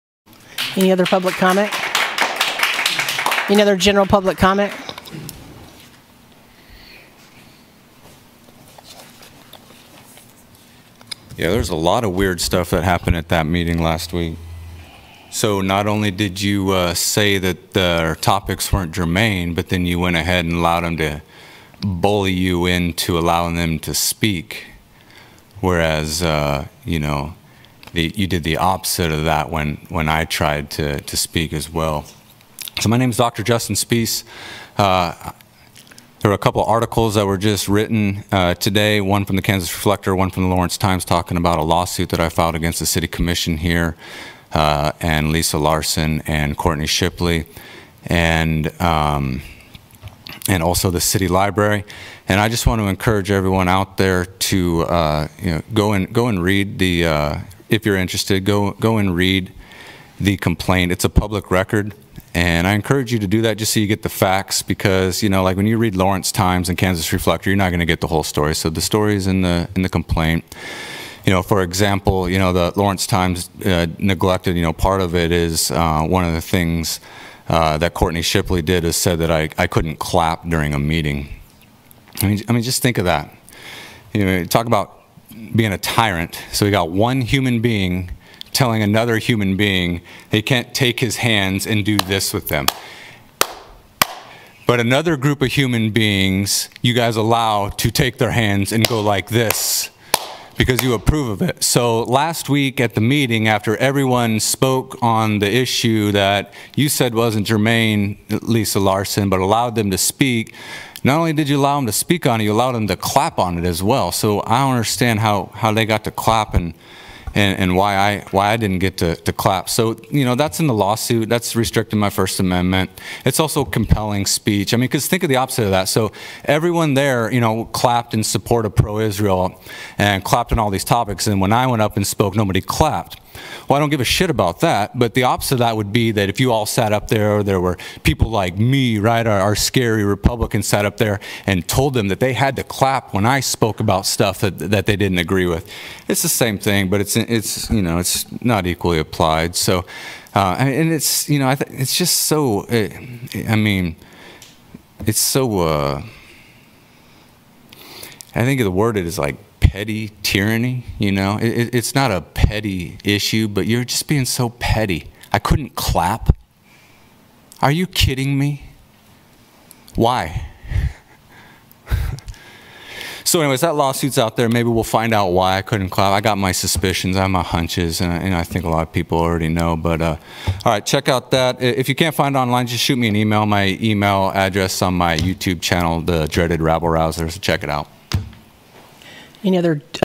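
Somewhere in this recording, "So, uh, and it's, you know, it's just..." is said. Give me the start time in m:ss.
2:29.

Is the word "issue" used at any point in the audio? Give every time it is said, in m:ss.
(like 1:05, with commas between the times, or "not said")
1:45, 2:43.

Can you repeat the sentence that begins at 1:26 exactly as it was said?
So we got one human being telling another human being he can't take his hands and do this with them.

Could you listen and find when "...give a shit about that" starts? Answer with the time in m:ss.
2:13.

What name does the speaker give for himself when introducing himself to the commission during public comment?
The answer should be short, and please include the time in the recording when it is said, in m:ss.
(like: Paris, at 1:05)
Dr. Justin Spiehs, at 0:33.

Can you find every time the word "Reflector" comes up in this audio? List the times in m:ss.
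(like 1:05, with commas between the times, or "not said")
0:39, 1:07.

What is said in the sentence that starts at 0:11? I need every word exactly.
Yeah, there's a lot of weird stuff that happened at that meeting last week.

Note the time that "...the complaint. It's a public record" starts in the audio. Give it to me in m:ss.
1:00.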